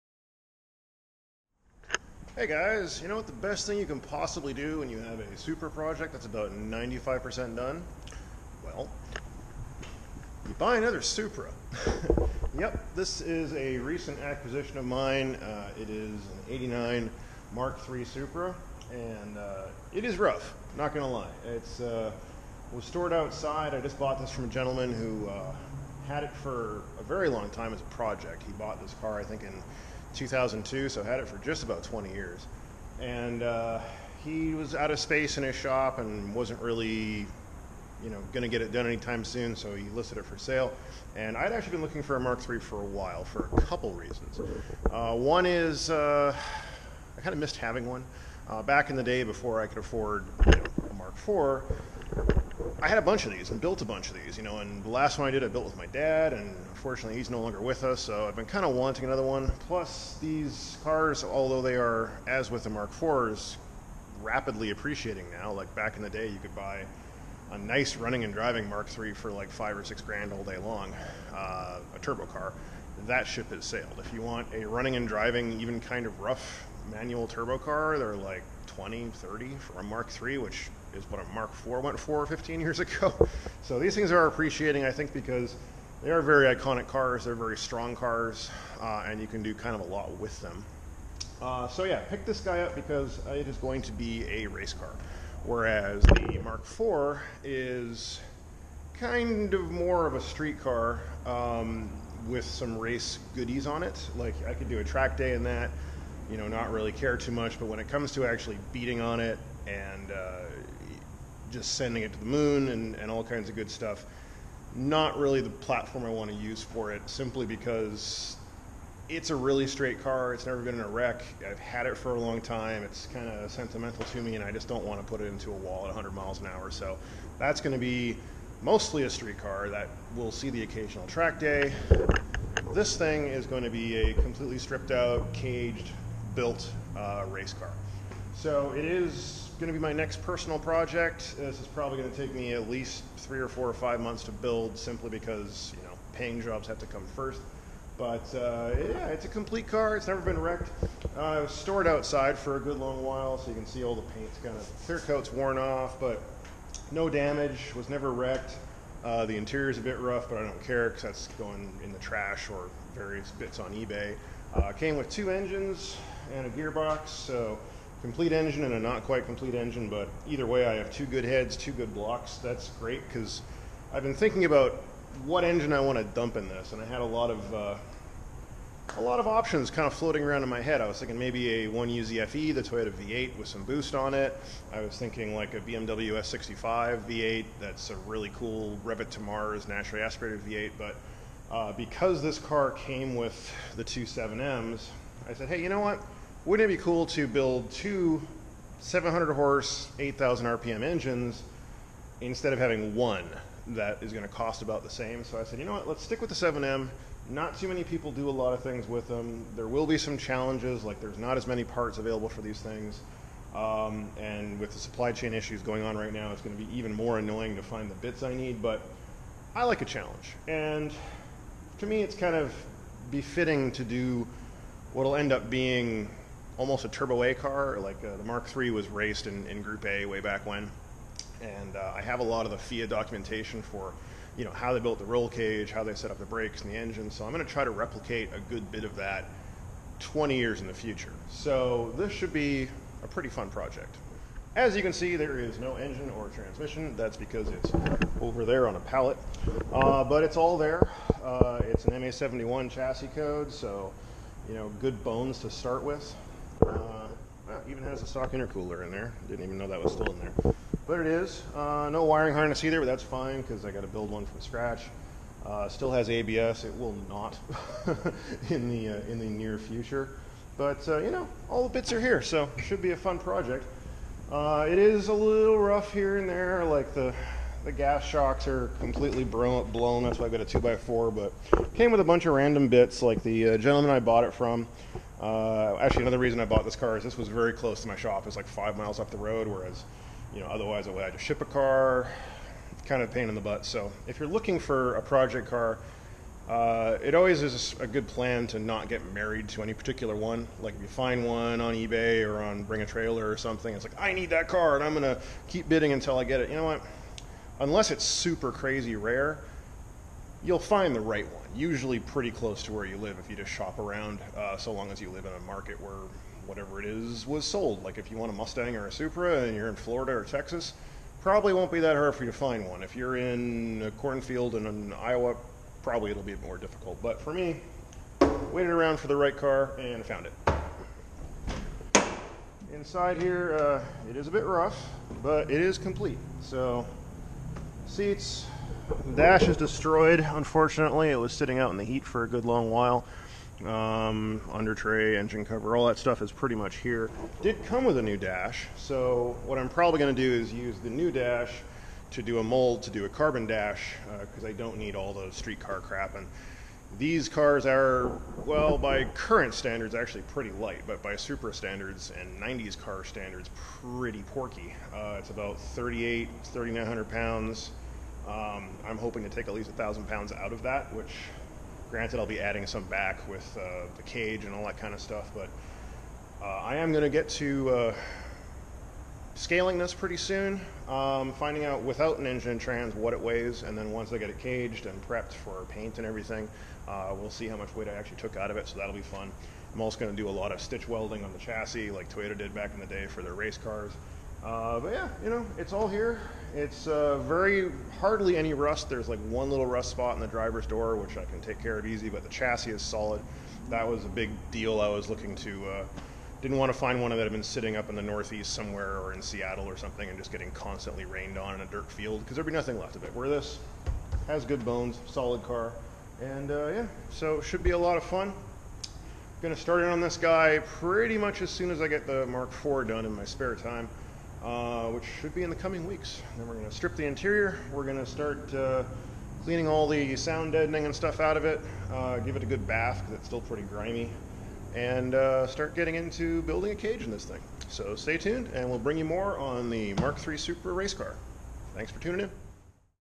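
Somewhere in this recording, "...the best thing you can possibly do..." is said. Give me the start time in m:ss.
0:03.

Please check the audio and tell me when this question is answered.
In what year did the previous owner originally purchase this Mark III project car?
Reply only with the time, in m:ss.
0:30.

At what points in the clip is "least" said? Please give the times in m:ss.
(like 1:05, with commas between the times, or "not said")
2:22, 6:09.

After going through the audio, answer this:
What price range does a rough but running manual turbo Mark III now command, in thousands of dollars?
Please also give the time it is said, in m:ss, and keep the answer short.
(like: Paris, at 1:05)
20 to 30 thousand, at 1:18.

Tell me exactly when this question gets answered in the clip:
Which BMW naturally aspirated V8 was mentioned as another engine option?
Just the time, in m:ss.
3:06.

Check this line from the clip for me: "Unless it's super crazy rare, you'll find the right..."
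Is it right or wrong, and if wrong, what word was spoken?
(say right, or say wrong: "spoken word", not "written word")
right.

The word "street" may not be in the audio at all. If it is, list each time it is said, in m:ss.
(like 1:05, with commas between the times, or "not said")
1:40, 2:09, 5:55.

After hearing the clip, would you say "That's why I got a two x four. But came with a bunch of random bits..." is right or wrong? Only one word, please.
right.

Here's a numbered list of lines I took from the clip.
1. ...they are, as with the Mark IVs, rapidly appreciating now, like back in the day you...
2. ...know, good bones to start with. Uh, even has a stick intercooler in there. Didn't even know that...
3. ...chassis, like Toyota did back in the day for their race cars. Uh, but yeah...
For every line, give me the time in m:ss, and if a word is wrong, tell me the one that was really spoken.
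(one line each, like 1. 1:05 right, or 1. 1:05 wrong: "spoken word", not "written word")
1. 1:01 right
2. 4:14 wrong: "stock", not "stick"
3. 6:31 right.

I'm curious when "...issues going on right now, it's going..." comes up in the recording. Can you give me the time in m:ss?
3:35.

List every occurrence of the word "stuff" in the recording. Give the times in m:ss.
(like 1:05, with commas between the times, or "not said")
1:53, 5:45, 6:15, 7:10.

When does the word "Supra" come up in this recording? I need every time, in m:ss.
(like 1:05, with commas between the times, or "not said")
0:05, 0:11, 0:18, 5:18, 7:20.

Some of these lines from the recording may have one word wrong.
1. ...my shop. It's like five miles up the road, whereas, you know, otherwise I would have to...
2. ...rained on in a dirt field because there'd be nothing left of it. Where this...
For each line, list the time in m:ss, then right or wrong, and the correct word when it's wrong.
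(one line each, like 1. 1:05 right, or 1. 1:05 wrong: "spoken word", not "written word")
1. 4:47 right
2. 6:51 right.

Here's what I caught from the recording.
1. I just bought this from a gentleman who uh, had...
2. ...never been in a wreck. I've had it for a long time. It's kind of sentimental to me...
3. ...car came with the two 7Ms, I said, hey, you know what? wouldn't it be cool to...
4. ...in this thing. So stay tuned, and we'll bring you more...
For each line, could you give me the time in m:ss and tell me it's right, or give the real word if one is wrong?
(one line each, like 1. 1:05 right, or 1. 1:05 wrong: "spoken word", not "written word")
1. 0:23 right
2. 2:00 right
3. 3:12 right
4. 7:17 right.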